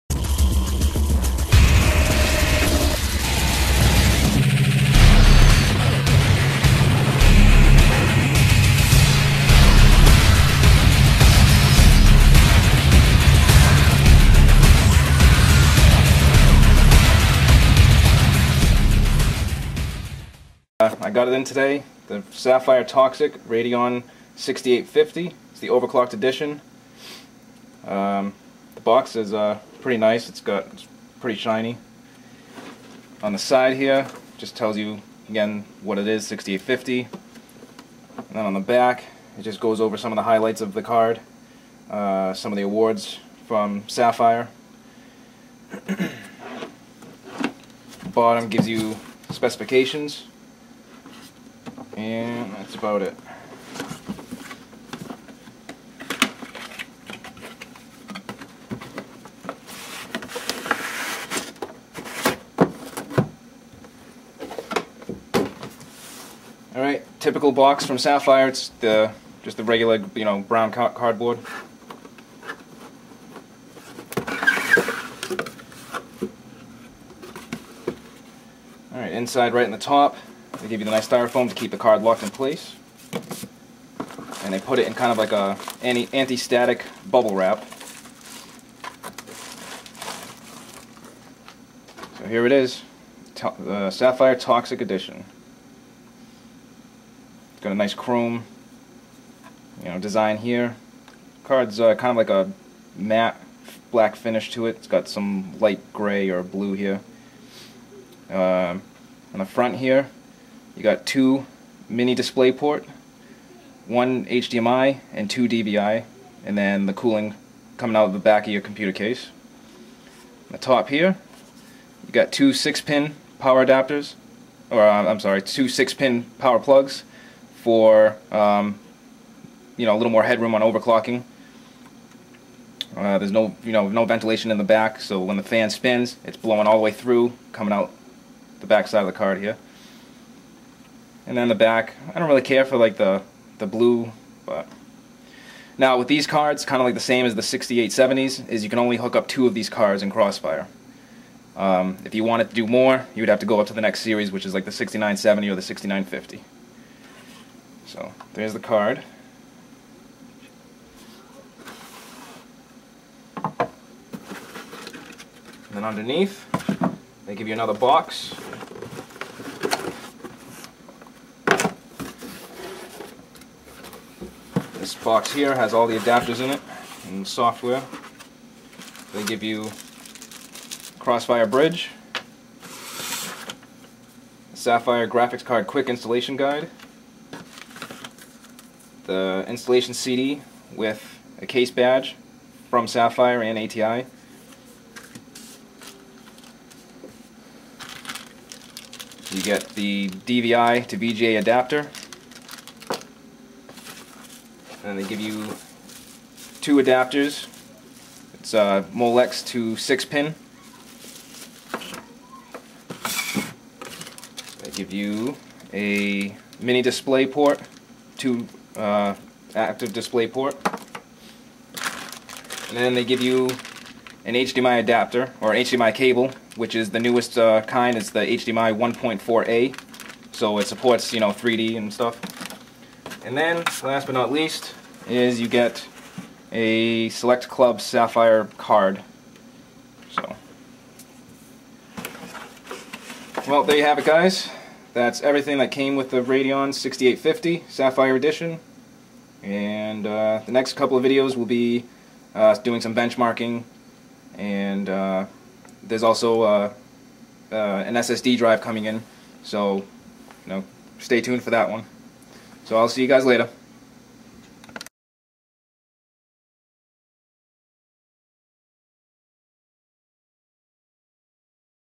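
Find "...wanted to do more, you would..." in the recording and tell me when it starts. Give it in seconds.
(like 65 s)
152 s.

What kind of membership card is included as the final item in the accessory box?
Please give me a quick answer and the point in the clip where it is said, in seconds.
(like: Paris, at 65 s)
Select Club Sapphire card, at 237 s.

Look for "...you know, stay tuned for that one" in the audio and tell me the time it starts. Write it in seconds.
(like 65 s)
259 s.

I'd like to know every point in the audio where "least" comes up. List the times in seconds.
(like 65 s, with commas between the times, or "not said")
234 s.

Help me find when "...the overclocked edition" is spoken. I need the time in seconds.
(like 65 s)
25 s.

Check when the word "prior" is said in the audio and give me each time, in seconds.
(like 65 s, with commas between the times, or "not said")
not said.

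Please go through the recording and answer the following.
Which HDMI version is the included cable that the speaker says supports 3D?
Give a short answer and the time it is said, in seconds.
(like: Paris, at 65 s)
1.4a, at 228 s.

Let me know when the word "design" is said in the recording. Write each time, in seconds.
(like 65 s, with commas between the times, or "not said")
99 s.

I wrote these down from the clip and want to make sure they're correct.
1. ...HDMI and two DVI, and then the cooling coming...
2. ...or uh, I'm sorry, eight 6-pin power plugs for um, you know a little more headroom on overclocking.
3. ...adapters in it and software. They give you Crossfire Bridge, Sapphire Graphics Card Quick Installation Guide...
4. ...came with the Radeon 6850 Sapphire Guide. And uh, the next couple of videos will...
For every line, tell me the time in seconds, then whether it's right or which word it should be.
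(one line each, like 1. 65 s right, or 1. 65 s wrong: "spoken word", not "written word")
1. 114 s right
2. 124 s wrong: "two", not "eight"
3. 175 s right
4. 245 s wrong: "Edition", not "Guide".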